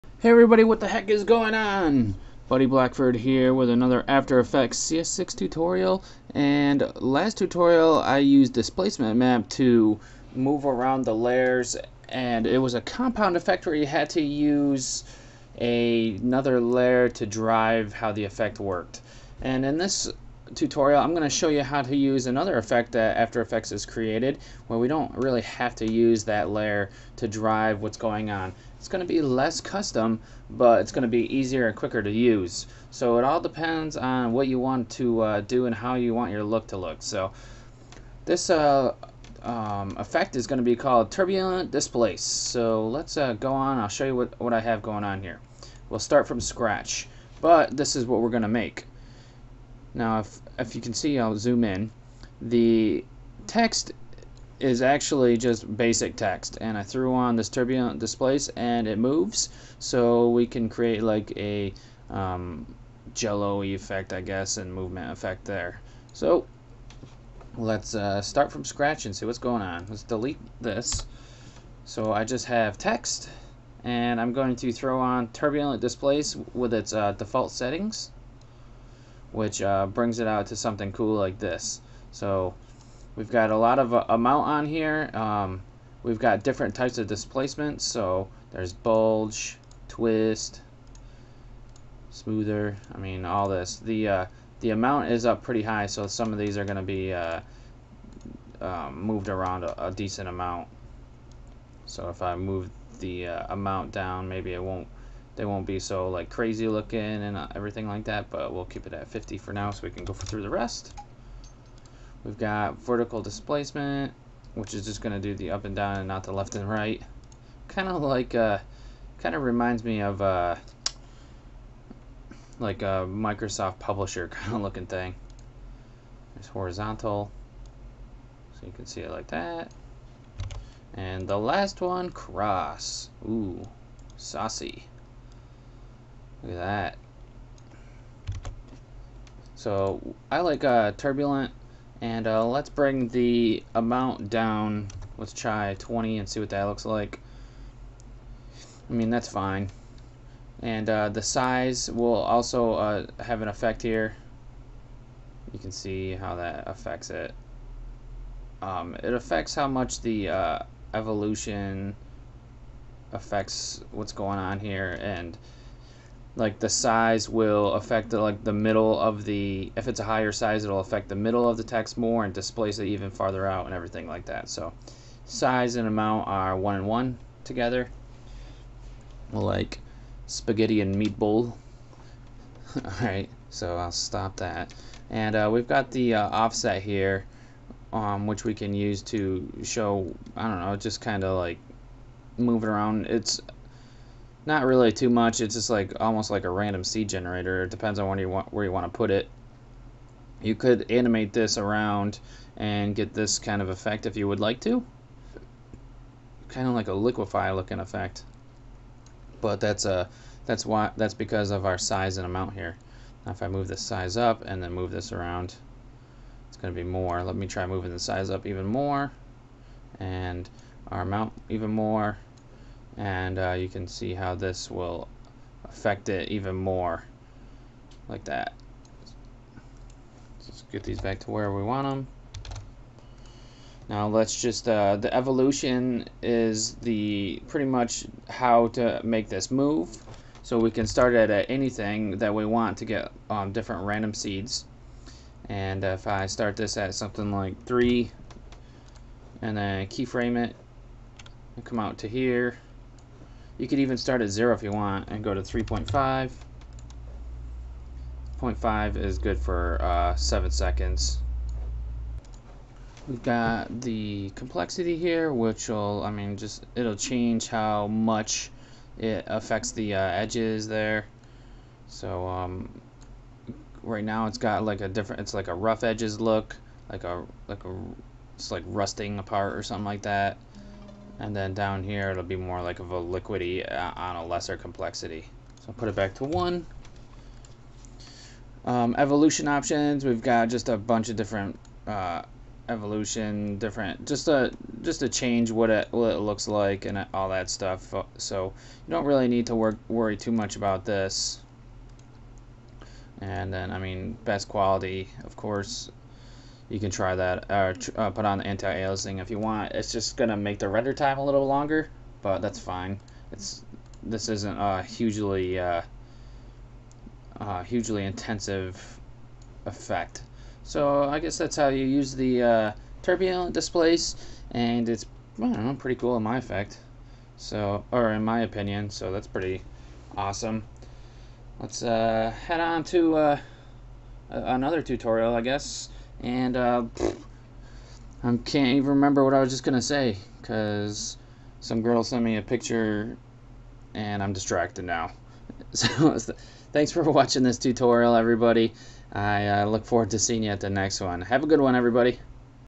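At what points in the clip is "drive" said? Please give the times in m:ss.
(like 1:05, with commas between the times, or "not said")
0:17, 0:27.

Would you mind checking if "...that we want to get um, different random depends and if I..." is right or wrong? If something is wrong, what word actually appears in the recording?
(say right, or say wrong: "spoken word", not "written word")
wrong: "seeds", not "depends".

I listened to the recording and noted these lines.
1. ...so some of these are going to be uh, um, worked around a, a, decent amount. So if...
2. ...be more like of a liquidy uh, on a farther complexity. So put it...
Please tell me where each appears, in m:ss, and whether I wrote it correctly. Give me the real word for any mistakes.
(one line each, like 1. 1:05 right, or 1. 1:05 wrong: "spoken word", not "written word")
1. 1:35 wrong: "moved", not "worked"
2. 4:42 wrong: "lesser", not "farther".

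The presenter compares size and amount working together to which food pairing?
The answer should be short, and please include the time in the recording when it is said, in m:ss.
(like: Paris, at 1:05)
Spaghetti and meatball, at 3:00.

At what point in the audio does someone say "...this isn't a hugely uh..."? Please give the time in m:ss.
5:14.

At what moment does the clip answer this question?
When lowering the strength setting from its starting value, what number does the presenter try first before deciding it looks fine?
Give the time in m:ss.
2:25.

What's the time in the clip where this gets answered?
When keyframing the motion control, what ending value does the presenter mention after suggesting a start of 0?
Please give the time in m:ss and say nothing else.
4:15.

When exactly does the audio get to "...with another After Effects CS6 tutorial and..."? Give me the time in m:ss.
0:03.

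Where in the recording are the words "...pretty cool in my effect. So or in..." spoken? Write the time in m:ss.
5:25.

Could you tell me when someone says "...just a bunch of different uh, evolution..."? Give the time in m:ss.
4:50.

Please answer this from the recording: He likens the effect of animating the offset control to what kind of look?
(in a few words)
Liquefy.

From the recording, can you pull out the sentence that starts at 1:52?
We've got vertical displacement, which is just going to do the up and down and not the left and right.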